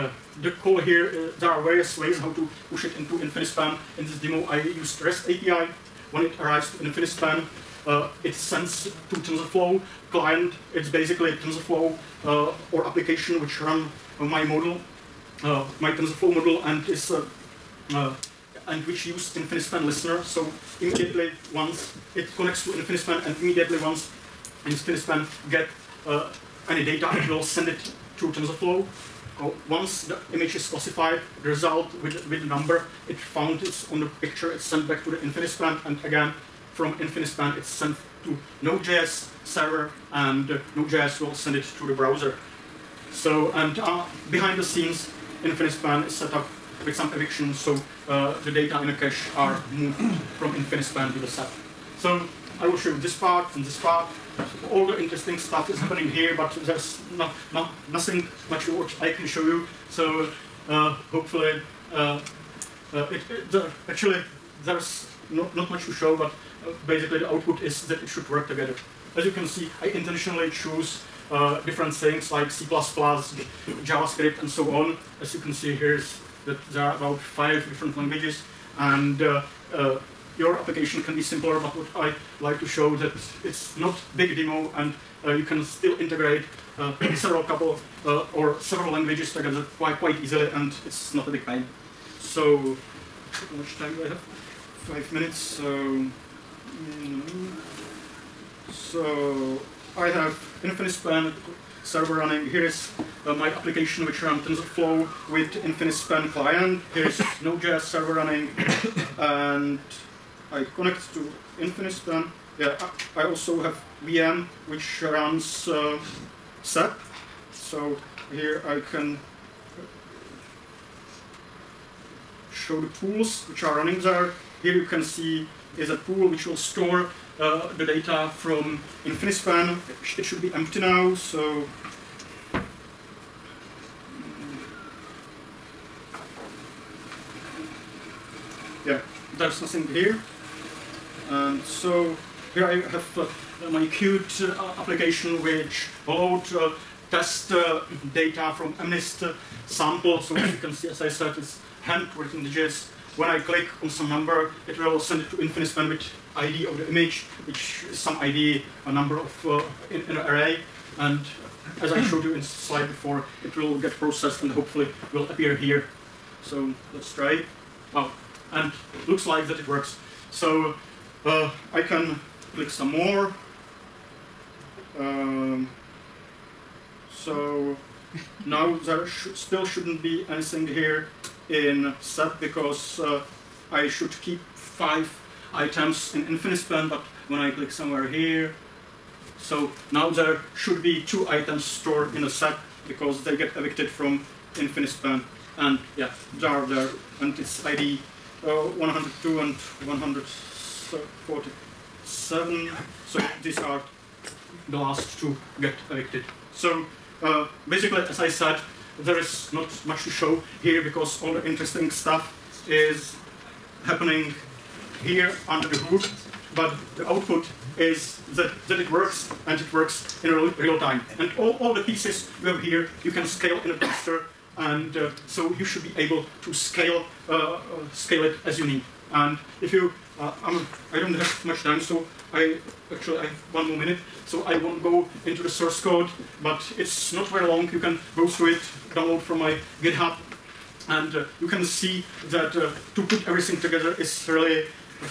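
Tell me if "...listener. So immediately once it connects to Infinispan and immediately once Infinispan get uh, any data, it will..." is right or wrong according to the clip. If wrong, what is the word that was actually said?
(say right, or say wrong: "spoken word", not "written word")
right.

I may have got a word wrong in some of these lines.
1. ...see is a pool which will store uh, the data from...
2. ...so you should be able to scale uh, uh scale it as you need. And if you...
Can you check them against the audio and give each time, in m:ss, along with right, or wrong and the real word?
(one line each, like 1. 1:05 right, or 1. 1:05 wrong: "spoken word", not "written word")
1. 2:05 right
2. 3:45 right.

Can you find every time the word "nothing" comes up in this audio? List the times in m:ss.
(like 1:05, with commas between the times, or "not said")
0:57, 2:19.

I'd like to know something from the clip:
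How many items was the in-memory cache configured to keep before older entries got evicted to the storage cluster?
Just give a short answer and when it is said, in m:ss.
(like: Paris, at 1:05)
5, at 3:04.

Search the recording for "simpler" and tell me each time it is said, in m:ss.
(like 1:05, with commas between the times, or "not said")
1:21.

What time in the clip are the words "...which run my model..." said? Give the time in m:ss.
0:13.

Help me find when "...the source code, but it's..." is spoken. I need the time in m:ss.
3:55.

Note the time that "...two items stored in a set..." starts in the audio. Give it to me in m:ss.
3:11.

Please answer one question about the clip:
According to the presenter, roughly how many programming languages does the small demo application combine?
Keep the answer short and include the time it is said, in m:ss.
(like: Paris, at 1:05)
5, at 1:17.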